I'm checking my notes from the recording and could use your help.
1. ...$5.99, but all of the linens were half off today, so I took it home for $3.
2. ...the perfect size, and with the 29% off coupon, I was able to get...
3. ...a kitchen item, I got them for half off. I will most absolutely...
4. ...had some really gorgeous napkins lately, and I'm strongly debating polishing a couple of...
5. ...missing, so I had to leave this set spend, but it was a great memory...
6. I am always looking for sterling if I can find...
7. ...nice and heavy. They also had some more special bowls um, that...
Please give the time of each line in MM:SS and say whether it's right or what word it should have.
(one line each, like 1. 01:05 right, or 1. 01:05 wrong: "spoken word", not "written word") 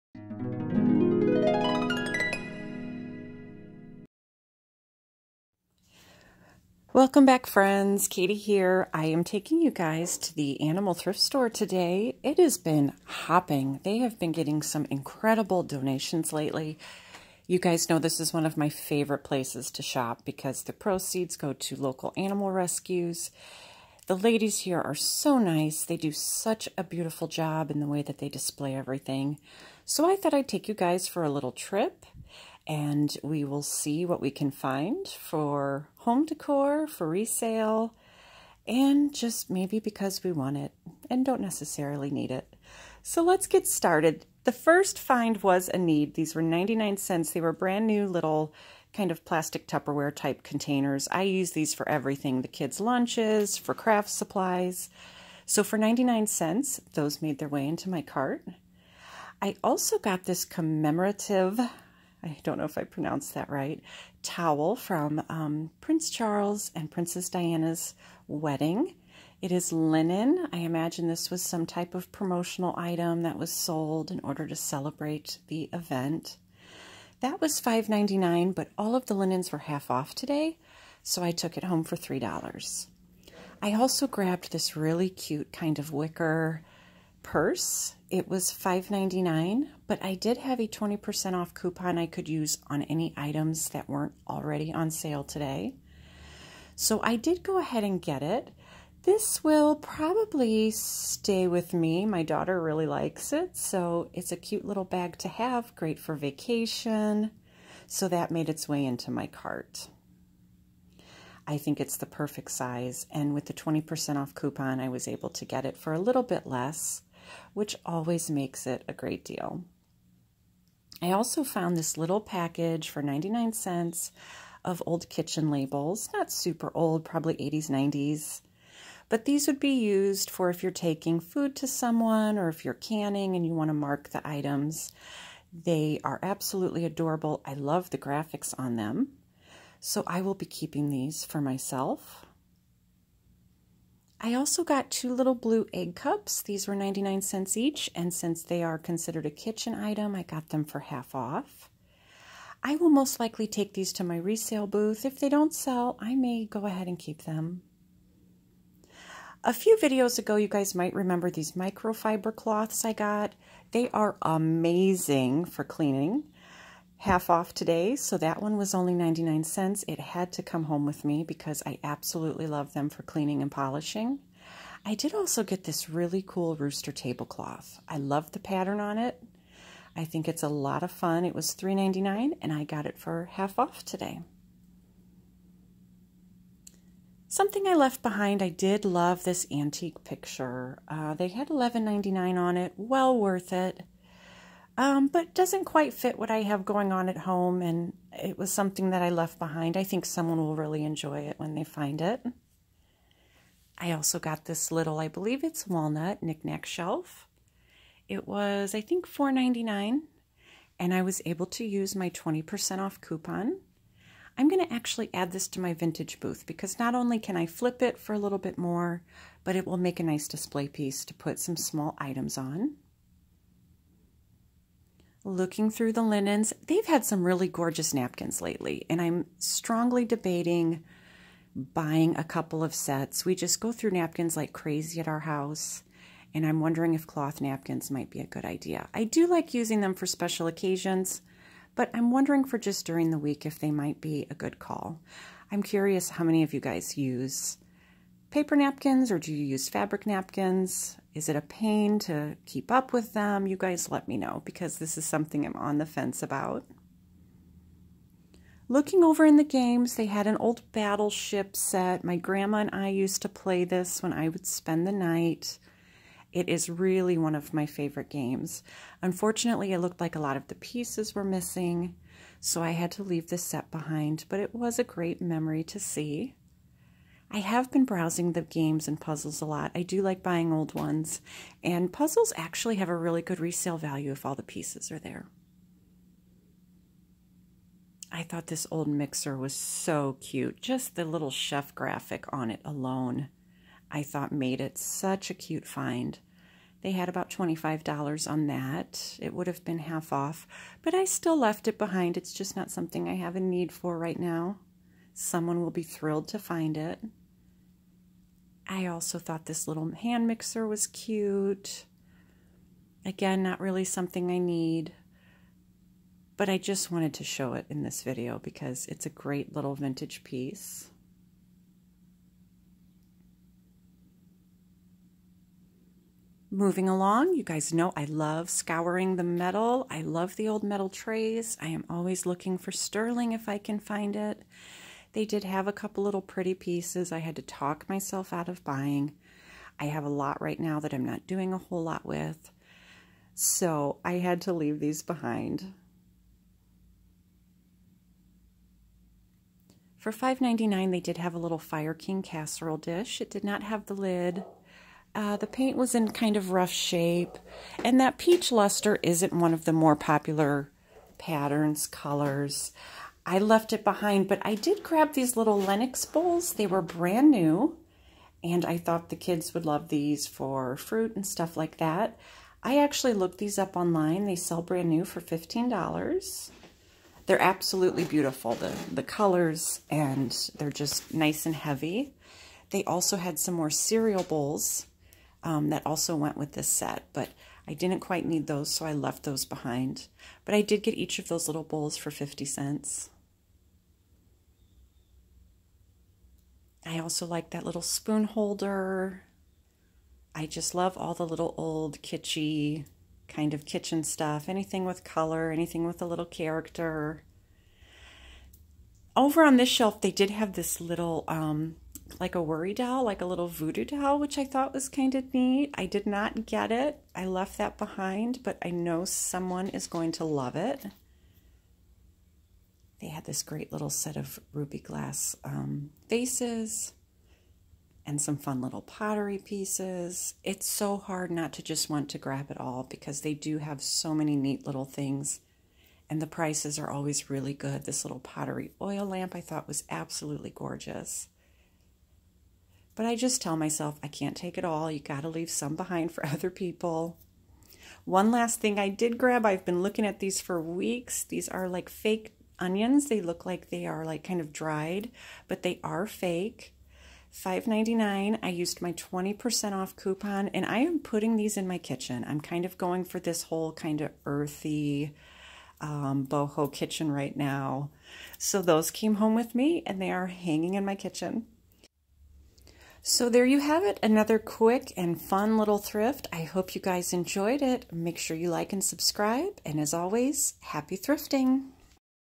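1. 01:17 right
2. 01:51 wrong: "20", not "29"
3. 02:29 wrong: "likely", not "absolutely"
4. 03:46 wrong: "buying", not "polishing"
5. 04:31 wrong: "behind", not "spend"
6. 05:31 right
7. 06:21 wrong: "cereal", not "special".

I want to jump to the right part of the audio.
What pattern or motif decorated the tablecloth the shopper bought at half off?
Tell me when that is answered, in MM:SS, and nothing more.
02:56.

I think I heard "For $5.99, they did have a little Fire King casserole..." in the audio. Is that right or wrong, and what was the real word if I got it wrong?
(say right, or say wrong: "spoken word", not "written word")
right.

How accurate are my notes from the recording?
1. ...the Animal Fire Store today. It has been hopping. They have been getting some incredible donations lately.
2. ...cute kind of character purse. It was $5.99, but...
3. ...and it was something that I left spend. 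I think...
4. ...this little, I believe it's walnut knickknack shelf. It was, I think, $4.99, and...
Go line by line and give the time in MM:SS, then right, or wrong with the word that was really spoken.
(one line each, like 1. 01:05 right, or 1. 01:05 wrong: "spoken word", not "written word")
1. 00:10 wrong: "Thrift", not "Fire"
2. 01:25 wrong: "wicker", not "character"
3. 03:17 wrong: "behind", not "spend"
4. 03:24 right.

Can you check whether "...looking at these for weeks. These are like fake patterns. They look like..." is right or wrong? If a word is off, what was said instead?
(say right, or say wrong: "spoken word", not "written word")
wrong: "onions", not "patterns".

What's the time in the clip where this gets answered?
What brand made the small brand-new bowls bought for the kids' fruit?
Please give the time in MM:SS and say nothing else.
06:05.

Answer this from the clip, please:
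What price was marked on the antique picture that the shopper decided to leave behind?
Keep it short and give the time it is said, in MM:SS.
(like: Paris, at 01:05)
$11.99, at 03:11.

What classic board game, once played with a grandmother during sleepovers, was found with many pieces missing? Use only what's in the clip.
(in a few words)
Battleship.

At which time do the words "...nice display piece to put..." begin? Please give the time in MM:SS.
03:40.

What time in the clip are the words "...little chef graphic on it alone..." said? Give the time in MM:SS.
04:51.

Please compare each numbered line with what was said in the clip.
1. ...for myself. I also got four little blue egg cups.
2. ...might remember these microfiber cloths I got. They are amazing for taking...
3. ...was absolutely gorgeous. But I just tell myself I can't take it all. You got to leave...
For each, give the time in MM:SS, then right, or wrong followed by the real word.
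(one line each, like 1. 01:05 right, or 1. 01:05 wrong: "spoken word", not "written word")
1. 02:21 wrong: "two", not "four"
2. 02:40 wrong: "cleaning", not "taking"
3. 07:19 right.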